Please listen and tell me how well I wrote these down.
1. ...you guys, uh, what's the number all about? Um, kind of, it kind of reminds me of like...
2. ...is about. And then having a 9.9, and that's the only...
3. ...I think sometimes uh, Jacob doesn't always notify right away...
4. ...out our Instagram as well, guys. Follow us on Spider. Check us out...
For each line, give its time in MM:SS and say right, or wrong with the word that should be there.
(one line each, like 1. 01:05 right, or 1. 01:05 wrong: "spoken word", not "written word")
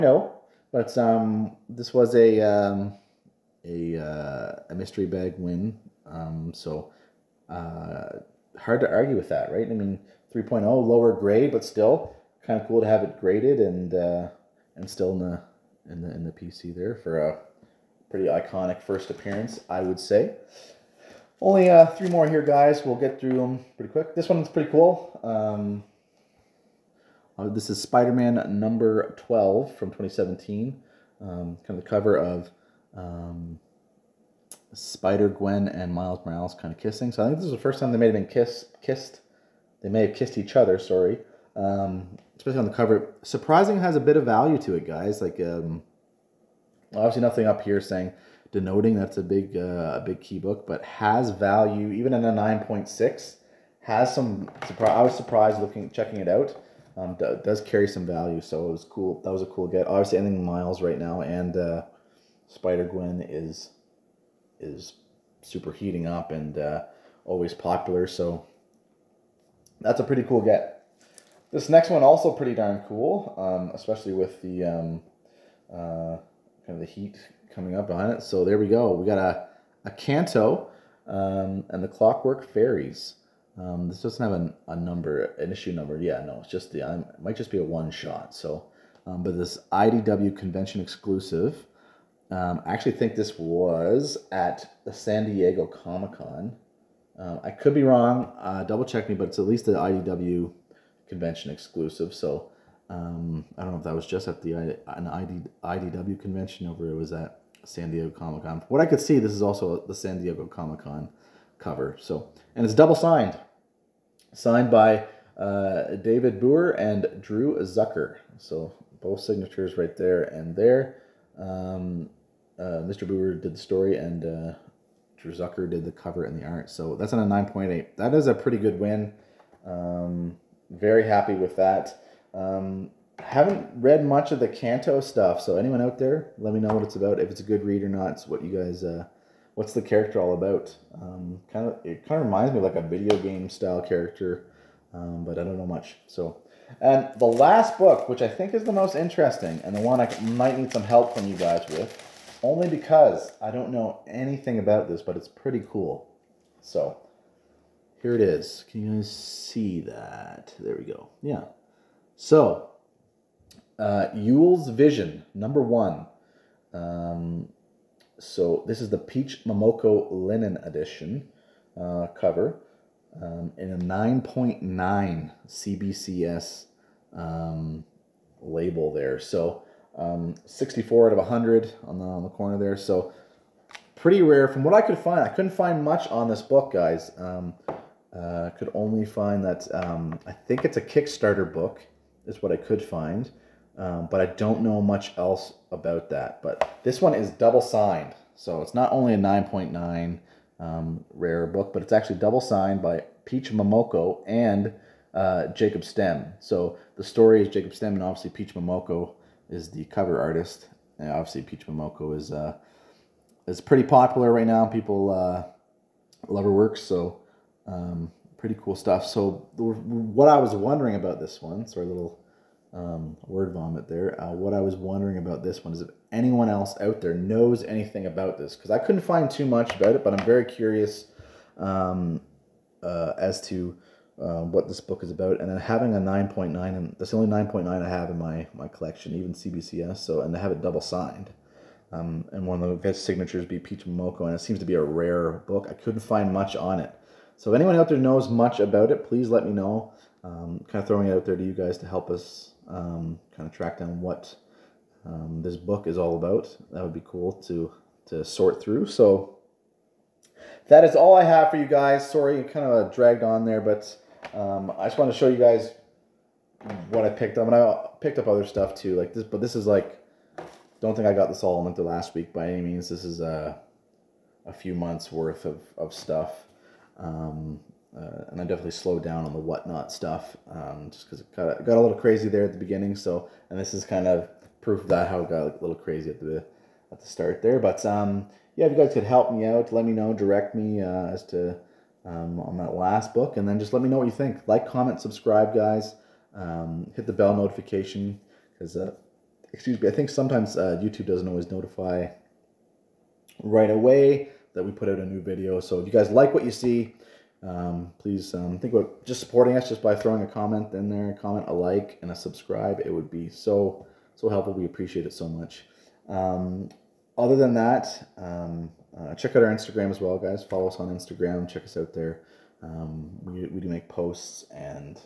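1. 02:18 wrong: "character", not "number"
2. 03:55 right
3. 04:59 wrong: "YouTube", not "Jacob"
4. 05:19 wrong: "Instagram", not "Spider".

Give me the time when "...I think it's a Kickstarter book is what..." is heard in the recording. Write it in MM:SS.
03:10.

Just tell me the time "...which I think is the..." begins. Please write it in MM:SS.
02:28.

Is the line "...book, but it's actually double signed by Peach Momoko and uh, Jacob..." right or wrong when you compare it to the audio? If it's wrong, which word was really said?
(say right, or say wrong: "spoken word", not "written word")
right.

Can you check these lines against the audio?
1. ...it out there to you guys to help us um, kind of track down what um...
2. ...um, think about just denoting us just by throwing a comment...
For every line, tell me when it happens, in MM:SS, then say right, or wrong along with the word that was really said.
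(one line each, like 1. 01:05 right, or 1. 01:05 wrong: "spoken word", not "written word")
1. 04:11 right
2. 05:08 wrong: "supporting", not "denoting".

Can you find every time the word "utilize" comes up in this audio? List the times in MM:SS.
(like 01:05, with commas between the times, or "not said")
not said.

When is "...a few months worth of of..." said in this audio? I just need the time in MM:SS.
04:34.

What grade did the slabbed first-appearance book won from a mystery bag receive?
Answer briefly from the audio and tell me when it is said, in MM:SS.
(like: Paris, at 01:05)
3.0, at 00:10.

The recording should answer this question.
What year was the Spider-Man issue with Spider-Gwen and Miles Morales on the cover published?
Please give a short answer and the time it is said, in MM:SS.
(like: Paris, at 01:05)
2017, at 00:29.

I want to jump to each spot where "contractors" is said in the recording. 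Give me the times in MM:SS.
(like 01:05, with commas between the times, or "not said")
not said.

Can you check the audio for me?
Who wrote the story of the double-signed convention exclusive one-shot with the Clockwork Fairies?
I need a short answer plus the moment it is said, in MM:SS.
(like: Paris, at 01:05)
David Booher, at 01:55.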